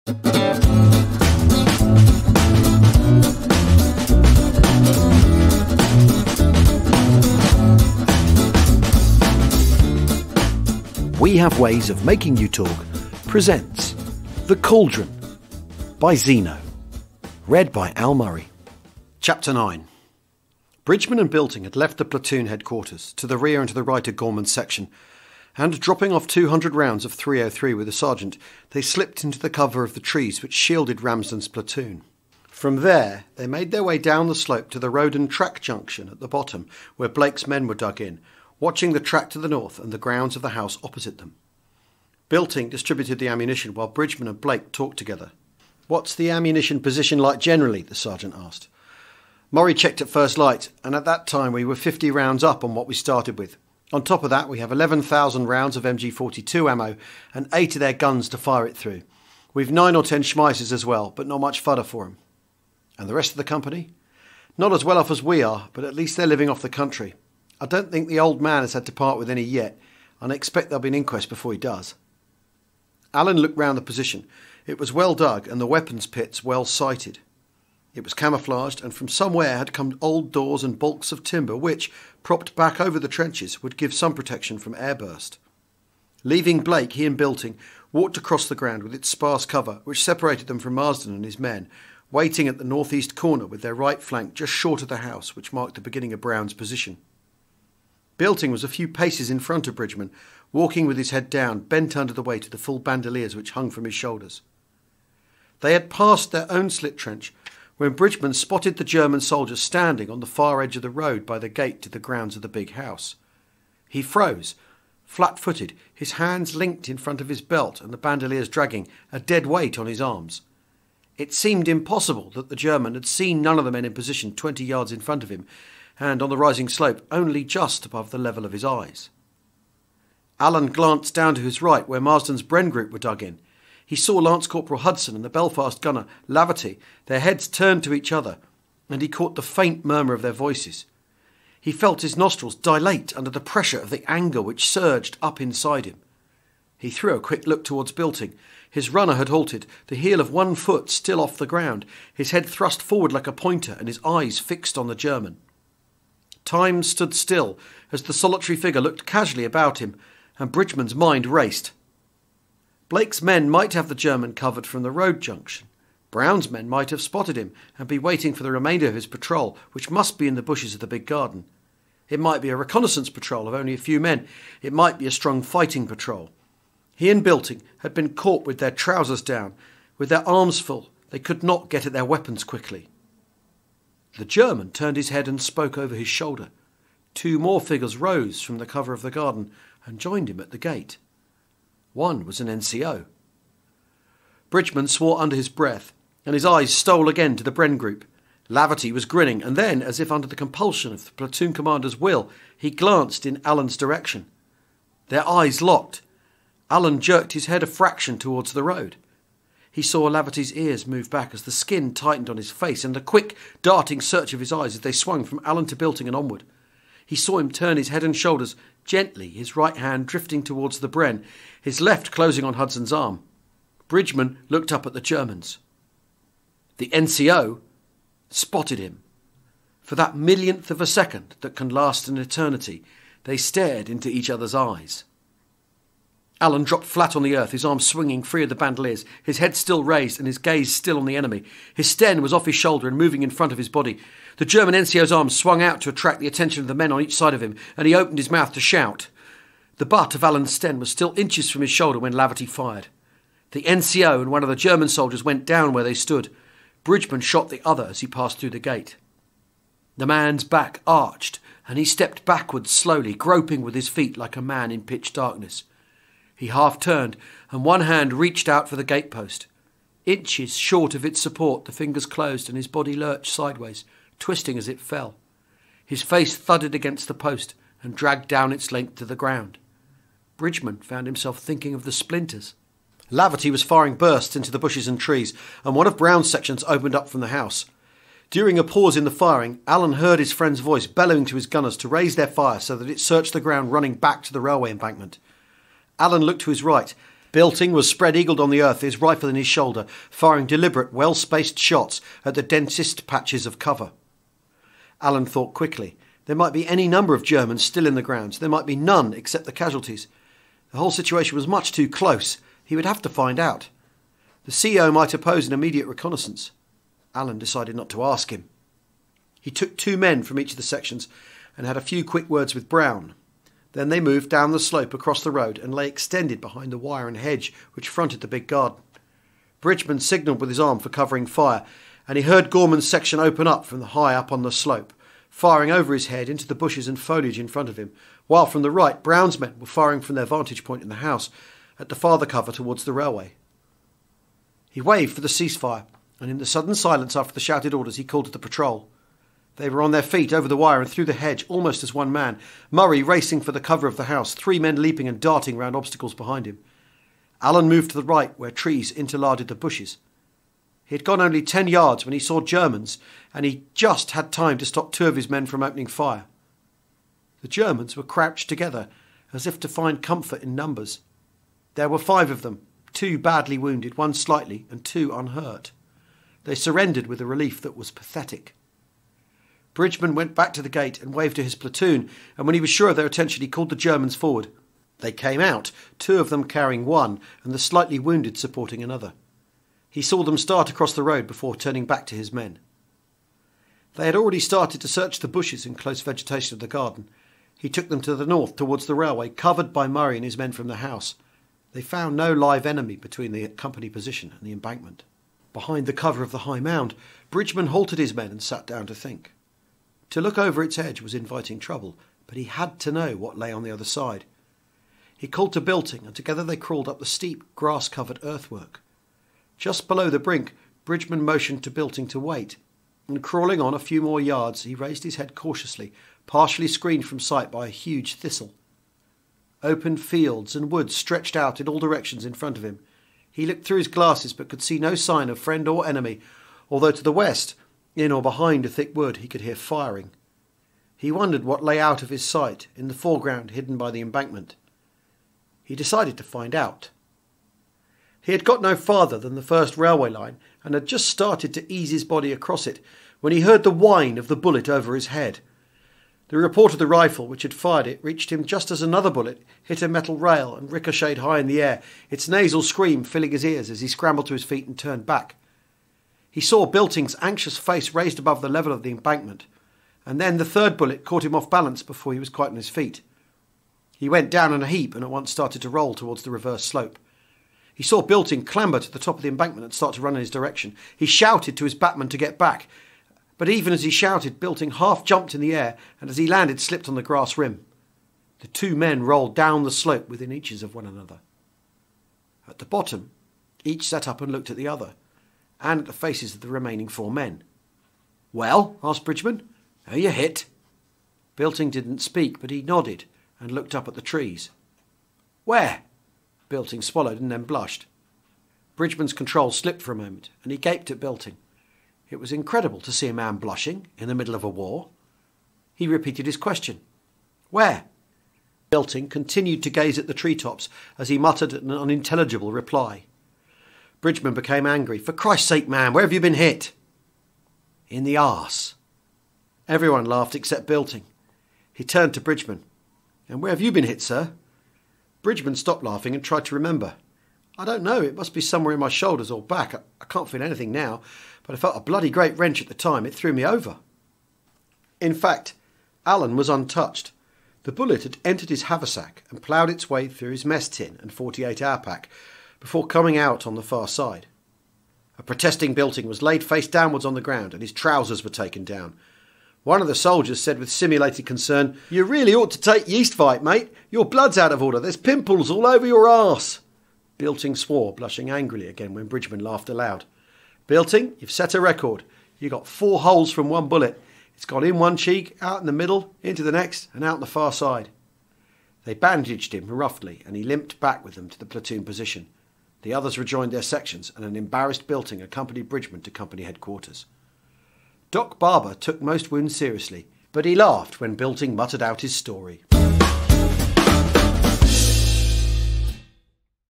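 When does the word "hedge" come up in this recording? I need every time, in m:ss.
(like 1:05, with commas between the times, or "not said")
5:27, 5:51.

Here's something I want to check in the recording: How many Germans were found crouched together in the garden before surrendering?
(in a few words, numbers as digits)
5.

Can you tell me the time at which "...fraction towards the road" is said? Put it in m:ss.
3:27.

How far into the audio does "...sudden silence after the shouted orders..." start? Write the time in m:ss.
5:46.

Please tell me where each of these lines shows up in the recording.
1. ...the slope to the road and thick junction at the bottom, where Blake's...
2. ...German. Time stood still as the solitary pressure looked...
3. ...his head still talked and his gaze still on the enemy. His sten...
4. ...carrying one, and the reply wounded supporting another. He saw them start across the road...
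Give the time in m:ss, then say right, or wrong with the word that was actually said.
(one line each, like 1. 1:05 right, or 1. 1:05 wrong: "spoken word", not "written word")
1. 0:34 wrong: "track", not "thick"
2. 2:34 wrong: "figure", not "pressure"
3. 3:59 wrong: "raised", not "talked"
4. 6:26 wrong: "slightly", not "reply".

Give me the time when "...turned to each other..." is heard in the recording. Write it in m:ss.
2:17.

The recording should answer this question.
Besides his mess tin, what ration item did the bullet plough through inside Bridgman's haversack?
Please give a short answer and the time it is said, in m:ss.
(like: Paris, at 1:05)
48 hour pack, at 9:11.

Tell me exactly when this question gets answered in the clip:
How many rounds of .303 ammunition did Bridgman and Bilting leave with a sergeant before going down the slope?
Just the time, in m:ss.
0:26.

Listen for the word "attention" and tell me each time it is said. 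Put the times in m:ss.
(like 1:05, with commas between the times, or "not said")
4:06, 6:23.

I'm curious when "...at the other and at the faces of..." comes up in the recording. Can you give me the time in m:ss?
8:14.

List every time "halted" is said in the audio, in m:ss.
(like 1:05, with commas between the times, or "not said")
2:29, 6:47.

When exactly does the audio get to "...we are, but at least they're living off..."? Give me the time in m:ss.
1:05.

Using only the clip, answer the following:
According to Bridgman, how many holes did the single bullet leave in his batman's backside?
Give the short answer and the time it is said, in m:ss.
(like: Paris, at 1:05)
4, at 9:32.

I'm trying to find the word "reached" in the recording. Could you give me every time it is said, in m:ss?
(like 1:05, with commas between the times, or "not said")
4:28, 7:38.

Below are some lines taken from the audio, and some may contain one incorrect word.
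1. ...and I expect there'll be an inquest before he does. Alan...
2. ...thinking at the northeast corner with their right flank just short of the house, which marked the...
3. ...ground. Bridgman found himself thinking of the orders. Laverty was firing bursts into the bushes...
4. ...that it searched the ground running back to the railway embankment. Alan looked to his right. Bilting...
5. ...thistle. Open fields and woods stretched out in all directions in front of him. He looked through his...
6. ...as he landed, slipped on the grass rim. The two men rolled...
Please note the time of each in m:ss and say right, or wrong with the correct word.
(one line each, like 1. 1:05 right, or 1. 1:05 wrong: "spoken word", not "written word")
1. 1:10 right
2. 1:32 wrong: "waiting", not "thinking"
3. 4:39 wrong: "splinters", not "orders"
4. 4:52 right
5. 7:08 right
6. 8:06 right.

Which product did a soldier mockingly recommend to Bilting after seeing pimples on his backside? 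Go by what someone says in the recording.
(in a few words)
Yeast-Vite.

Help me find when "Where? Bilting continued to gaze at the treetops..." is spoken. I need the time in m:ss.
8:37.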